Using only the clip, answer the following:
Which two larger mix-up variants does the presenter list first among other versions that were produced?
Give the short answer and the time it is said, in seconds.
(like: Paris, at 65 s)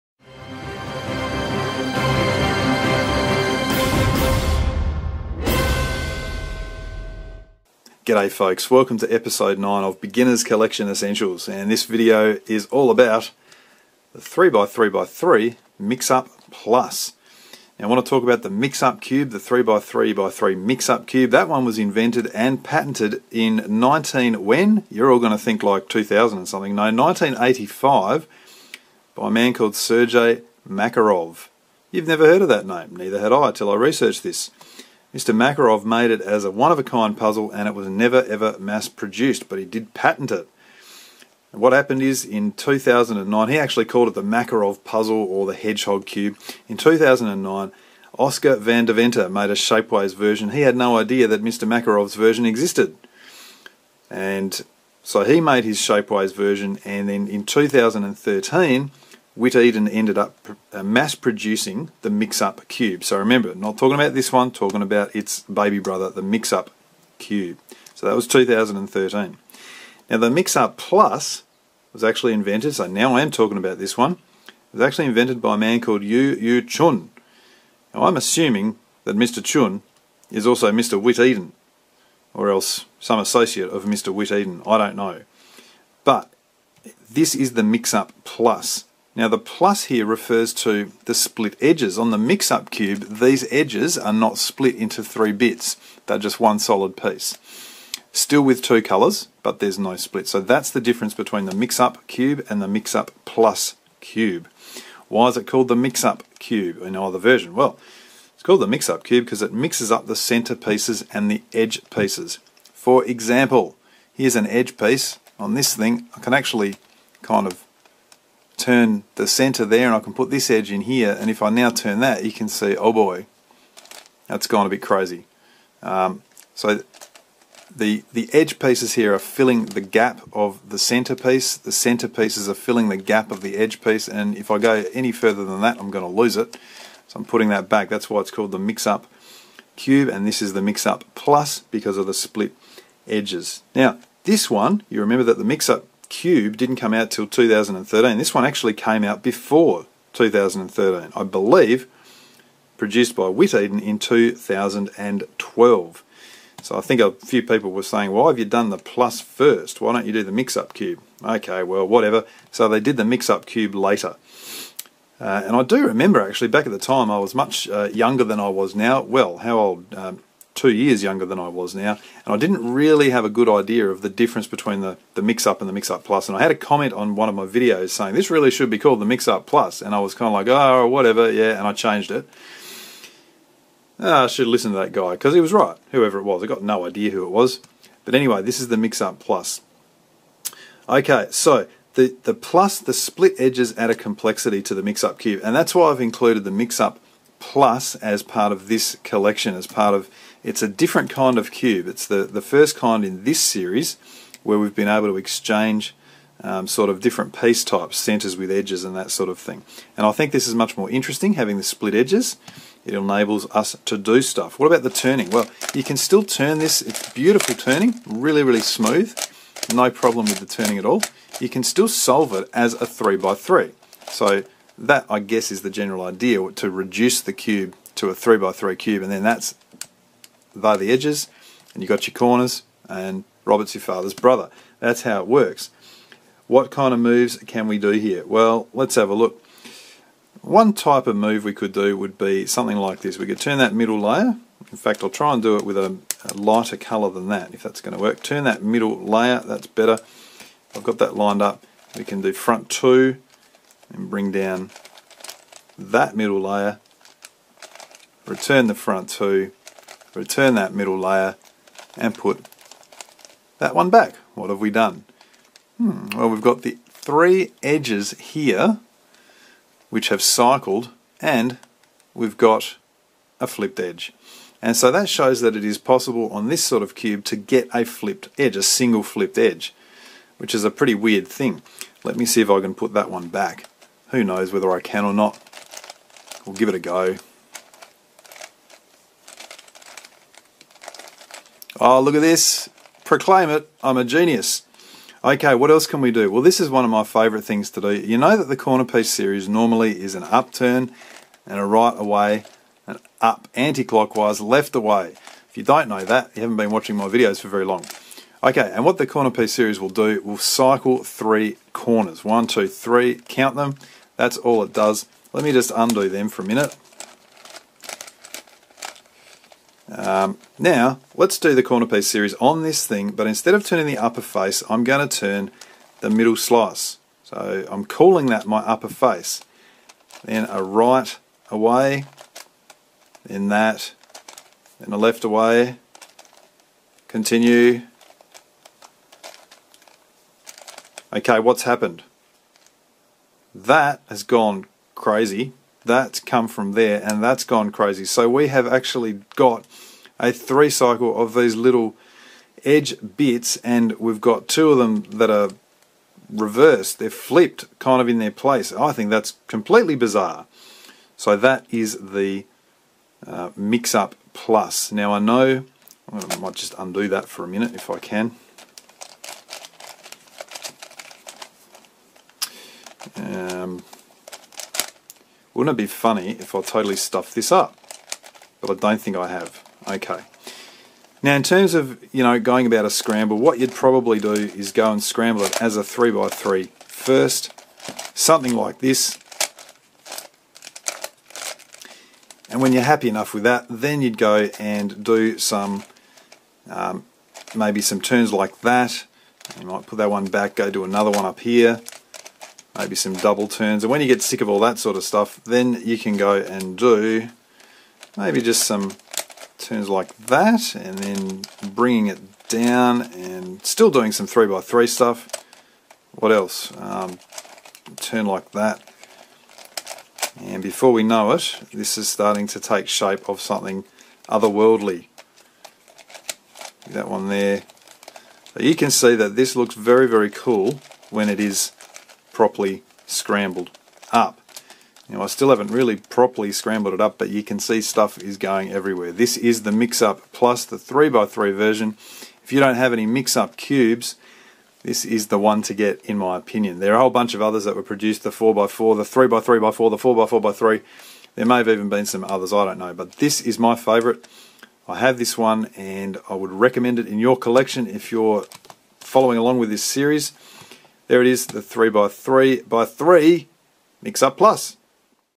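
the 4x4, the 3x3x4, at 448 s.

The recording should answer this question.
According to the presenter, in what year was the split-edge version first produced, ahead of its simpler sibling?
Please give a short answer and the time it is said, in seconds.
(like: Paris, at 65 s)
2012, at 153 s.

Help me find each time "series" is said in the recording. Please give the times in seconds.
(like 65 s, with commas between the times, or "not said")
203 s, 299 s, 309 s, 322 s, 459 s.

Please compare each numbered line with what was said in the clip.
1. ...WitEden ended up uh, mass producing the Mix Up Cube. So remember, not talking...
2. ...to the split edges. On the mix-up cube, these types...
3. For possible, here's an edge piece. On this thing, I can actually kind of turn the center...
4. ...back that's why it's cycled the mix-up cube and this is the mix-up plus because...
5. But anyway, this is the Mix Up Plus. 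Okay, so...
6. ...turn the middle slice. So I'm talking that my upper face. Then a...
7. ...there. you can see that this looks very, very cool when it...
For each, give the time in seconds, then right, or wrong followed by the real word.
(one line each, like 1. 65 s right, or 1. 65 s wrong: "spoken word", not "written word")
1. 59 s right
2. 90 s wrong: "edges", not "types"
3. 112 s wrong: "example", not "possible"
4. 137 s wrong: "called", not "cycled"
5. 188 s right
6. 325 s wrong: "calling", not "talking"
7. 427 s right.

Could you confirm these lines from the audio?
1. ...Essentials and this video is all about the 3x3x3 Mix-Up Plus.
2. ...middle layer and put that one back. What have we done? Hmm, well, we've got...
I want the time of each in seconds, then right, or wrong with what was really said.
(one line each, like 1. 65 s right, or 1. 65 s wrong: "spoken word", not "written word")
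1. 10 s right
2. 260 s right.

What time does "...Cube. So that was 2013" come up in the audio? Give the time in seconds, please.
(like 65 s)
67 s.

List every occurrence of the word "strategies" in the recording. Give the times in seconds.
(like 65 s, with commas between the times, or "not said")
not said.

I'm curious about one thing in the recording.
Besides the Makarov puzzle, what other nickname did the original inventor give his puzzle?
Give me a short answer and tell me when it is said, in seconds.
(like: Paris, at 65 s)
hedgehog cube, at 45 s.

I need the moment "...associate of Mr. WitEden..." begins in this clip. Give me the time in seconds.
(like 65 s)
83 s.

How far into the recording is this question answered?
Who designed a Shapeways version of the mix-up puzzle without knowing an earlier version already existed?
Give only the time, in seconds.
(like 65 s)
48 s.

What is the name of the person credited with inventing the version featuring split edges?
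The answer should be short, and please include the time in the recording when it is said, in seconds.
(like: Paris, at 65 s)
Yu Yu Chun, at 76 s.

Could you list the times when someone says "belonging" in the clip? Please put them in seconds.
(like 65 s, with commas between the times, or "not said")
not said.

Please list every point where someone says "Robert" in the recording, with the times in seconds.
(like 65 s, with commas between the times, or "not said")
233 s.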